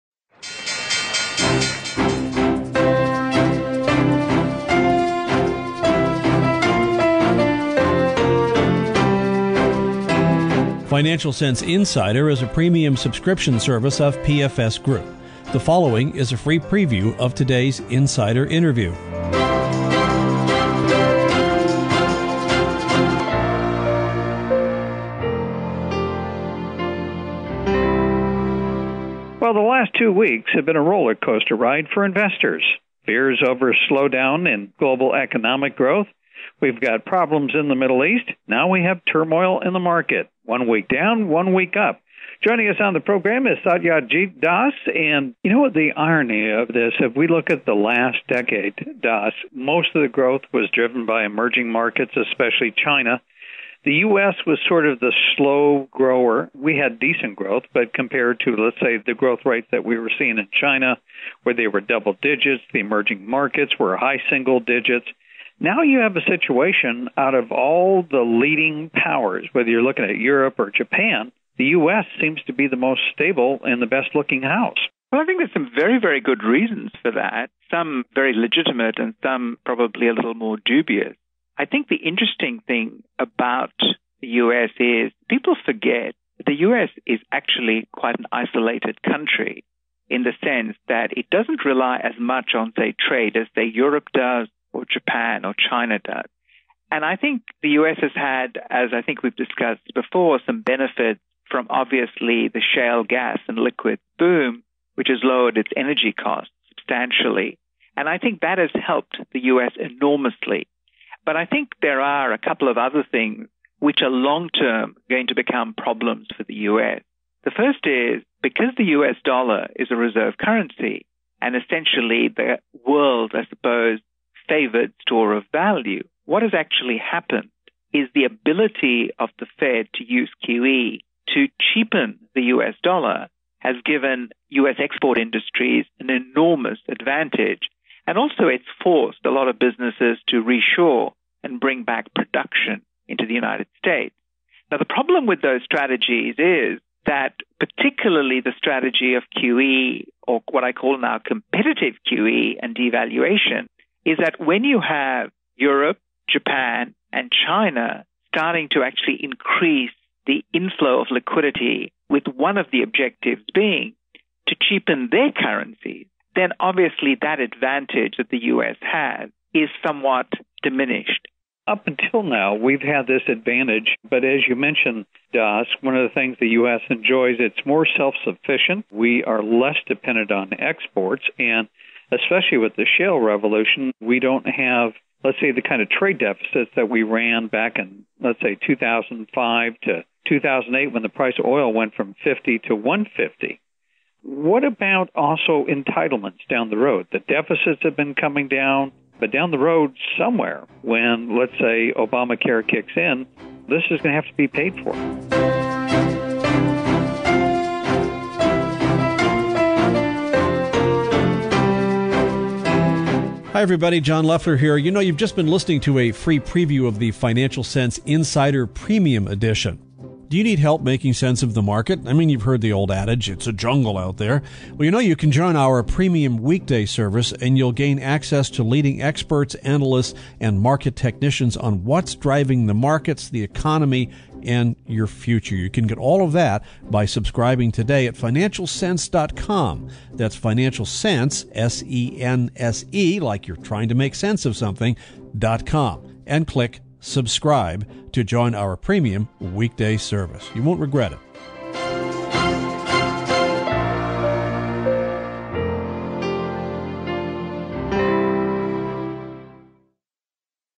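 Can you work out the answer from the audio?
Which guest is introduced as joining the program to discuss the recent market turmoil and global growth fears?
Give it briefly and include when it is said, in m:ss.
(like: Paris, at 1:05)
Satyajit Das, at 0:43.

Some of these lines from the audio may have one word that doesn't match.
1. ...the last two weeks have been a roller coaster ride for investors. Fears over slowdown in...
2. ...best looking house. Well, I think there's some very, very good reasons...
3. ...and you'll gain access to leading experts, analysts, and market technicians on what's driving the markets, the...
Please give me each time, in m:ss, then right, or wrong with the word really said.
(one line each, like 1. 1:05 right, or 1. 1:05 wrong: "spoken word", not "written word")
1. 0:29 right
2. 1:13 right
3. 3:47 right.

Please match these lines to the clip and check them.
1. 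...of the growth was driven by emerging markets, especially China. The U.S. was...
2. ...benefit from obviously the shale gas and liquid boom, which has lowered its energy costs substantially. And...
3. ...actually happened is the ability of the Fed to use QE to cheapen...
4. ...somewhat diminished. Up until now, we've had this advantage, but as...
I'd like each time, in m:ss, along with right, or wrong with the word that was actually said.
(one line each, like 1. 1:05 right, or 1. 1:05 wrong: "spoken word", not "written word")
1. 0:49 right
2. 1:40 right
3. 2:06 right
4. 2:49 right.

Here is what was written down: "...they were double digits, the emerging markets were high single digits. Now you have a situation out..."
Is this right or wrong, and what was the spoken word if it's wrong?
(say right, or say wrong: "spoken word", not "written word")
right.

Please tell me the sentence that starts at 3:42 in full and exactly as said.
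I mean, you've heard the old adage, it's a jungle out there.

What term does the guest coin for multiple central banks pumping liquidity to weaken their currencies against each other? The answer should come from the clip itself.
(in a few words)
competitive QE.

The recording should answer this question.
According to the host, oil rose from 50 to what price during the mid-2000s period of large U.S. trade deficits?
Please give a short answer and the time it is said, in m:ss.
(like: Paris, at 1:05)
150, at 3:12.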